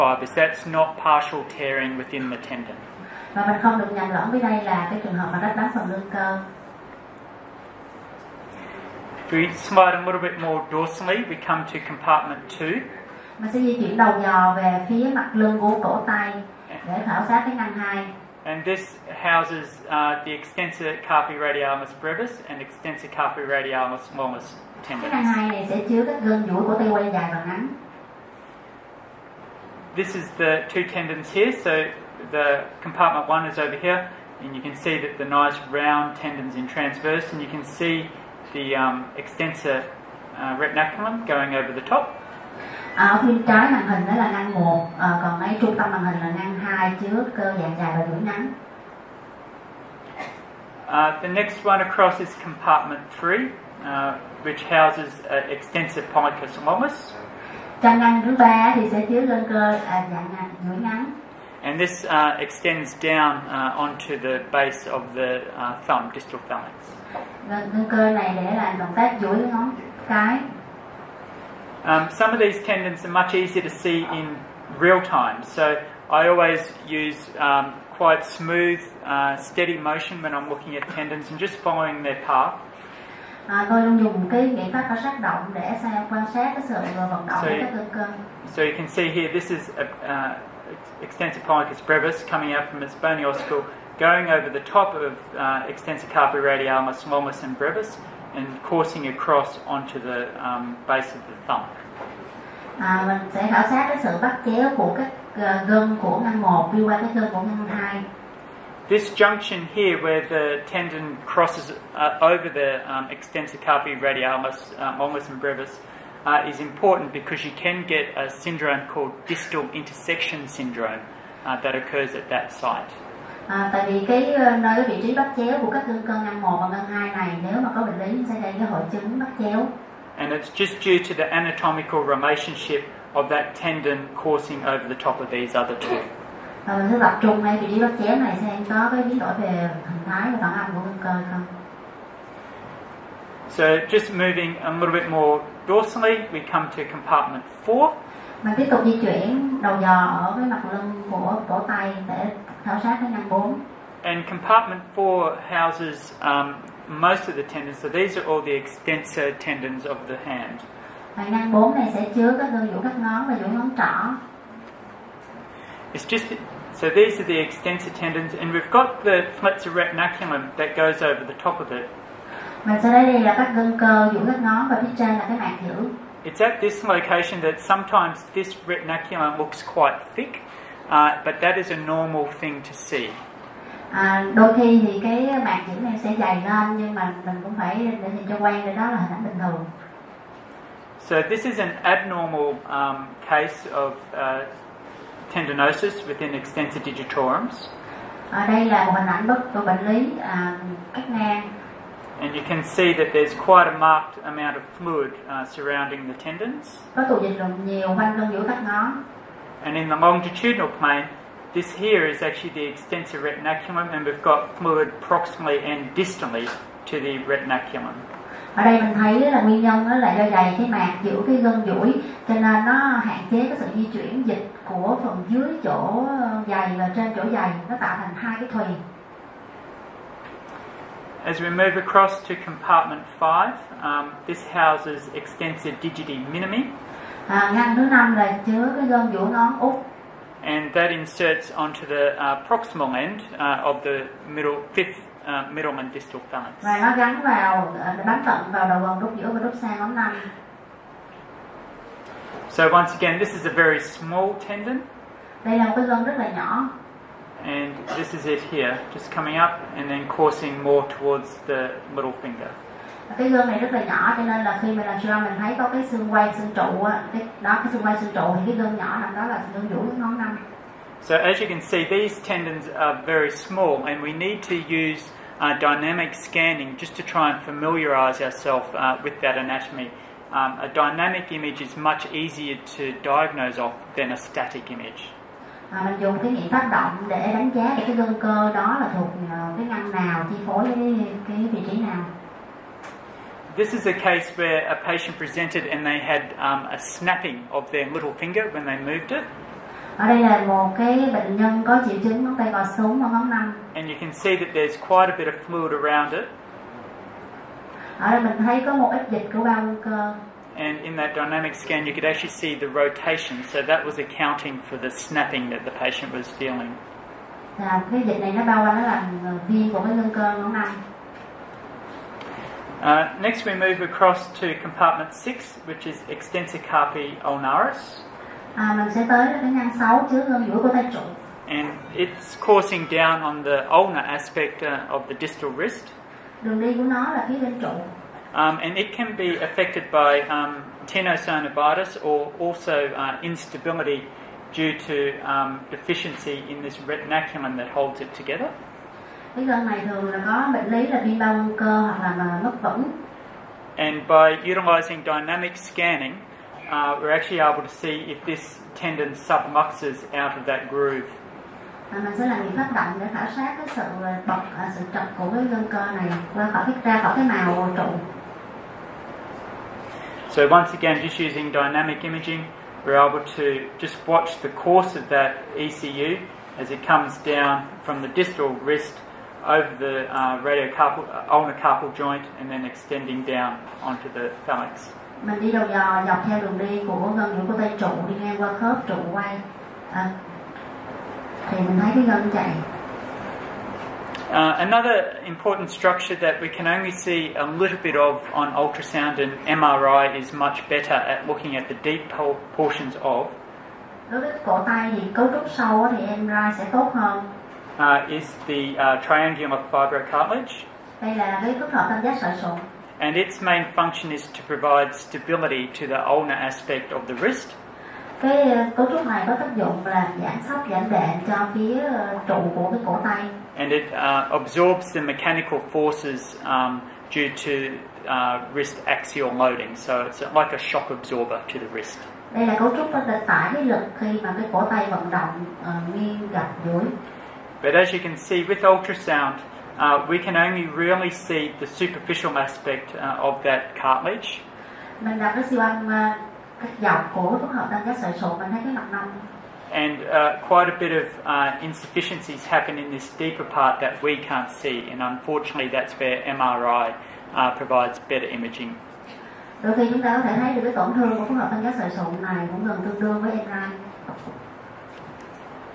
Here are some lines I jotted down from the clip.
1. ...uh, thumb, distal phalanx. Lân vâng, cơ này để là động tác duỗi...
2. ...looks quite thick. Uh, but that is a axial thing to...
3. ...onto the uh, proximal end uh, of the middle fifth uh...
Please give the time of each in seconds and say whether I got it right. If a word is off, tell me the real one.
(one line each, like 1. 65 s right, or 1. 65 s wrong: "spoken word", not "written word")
1. 65 s right
2. 179 s wrong: "normal", not "axial"
3. 241 s right.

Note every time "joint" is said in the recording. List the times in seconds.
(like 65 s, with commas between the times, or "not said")
381 s.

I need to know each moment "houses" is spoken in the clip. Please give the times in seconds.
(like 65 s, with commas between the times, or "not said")
19 s, 54 s, 155 s, 234 s.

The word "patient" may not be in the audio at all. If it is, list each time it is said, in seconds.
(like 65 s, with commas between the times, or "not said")
294 s, 315 s.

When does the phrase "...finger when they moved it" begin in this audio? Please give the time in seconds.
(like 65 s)
298 s.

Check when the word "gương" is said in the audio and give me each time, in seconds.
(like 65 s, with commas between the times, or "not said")
263 s, 268 s.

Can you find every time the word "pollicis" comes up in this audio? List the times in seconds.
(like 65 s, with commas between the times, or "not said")
91 s.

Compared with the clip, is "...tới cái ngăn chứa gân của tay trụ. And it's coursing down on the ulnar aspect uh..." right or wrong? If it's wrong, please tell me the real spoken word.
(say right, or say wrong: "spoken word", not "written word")
right.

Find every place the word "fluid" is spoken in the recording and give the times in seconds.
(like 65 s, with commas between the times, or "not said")
204 s, 214 s, 305 s.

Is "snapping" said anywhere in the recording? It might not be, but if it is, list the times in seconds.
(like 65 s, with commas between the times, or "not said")
296 s, 314 s.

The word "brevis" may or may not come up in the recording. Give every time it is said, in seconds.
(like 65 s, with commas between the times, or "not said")
21 s, 91 s, 97 s, 115 s.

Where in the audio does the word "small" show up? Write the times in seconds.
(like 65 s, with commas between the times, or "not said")
253 s, 273 s.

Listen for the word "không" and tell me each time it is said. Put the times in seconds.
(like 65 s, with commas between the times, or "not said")
3 s, 141 s.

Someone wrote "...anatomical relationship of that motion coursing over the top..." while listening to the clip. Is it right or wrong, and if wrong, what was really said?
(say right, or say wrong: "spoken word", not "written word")
wrong: "tendon", not "motion".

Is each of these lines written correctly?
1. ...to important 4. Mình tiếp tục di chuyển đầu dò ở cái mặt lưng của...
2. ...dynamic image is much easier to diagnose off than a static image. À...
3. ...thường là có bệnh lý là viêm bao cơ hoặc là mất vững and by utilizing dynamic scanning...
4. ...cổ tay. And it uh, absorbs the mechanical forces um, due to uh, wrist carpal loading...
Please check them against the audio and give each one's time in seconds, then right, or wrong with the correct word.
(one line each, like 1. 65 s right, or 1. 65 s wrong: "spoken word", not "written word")
1. 146 s wrong: "compartment", not "important"
2. 280 s right
3. 349 s right
4. 422 s wrong: "axial", not "carpal".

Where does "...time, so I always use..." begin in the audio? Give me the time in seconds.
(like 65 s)
75 s.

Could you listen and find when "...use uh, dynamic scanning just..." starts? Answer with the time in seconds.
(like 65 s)
274 s.